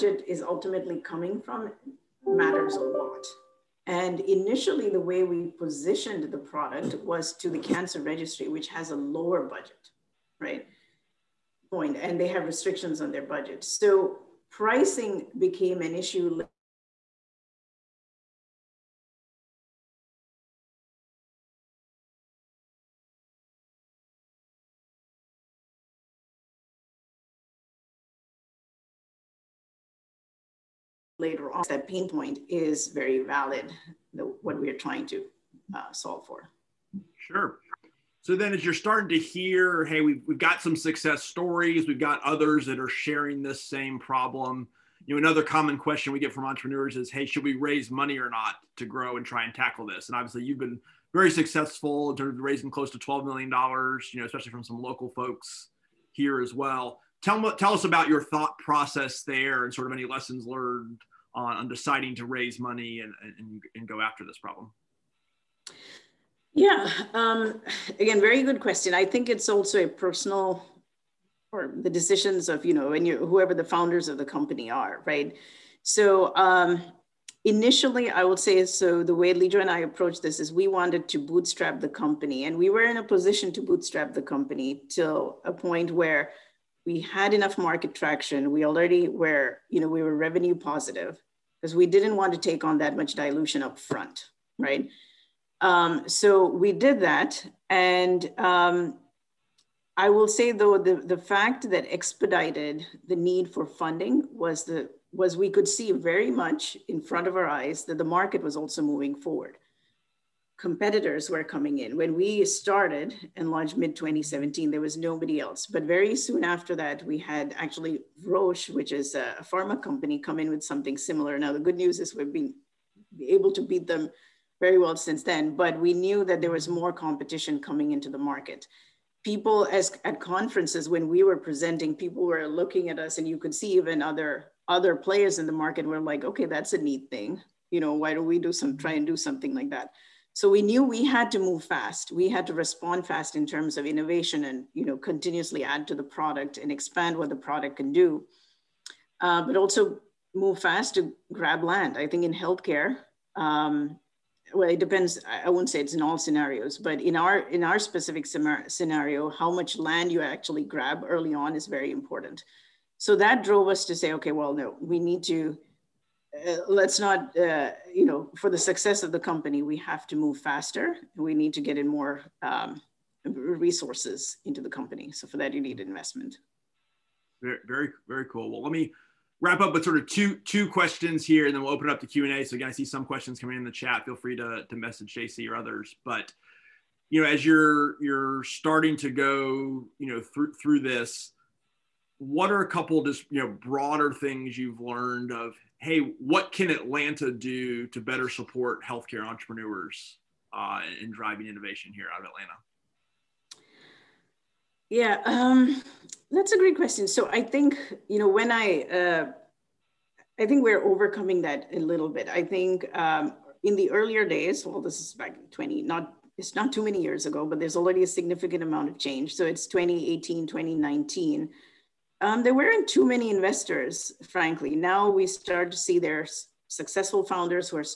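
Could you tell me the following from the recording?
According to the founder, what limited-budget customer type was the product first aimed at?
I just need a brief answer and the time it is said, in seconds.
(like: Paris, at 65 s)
Cancer registry, at 7 s.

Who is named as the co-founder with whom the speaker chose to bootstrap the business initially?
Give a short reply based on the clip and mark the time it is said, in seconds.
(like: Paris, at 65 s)
Lijo, at 79 s.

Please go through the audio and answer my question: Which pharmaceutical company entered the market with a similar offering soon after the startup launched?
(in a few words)
Roche.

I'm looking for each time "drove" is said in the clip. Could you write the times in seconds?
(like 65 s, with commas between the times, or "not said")
163 s.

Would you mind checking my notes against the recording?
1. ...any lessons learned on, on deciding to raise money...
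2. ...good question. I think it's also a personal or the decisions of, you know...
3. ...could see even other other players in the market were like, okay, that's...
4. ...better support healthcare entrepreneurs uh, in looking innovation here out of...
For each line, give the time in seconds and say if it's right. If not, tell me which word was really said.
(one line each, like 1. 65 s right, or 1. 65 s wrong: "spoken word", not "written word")
1. 59 s right
2. 68 s right
3. 133 s right
4. 197 s wrong: "driving", not "looking".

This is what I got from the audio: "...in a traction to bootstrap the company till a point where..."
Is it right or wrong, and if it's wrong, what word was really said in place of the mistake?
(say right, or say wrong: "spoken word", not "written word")
wrong: "position", not "traction".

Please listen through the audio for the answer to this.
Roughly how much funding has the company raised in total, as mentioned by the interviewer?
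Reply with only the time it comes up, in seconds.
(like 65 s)
52 s.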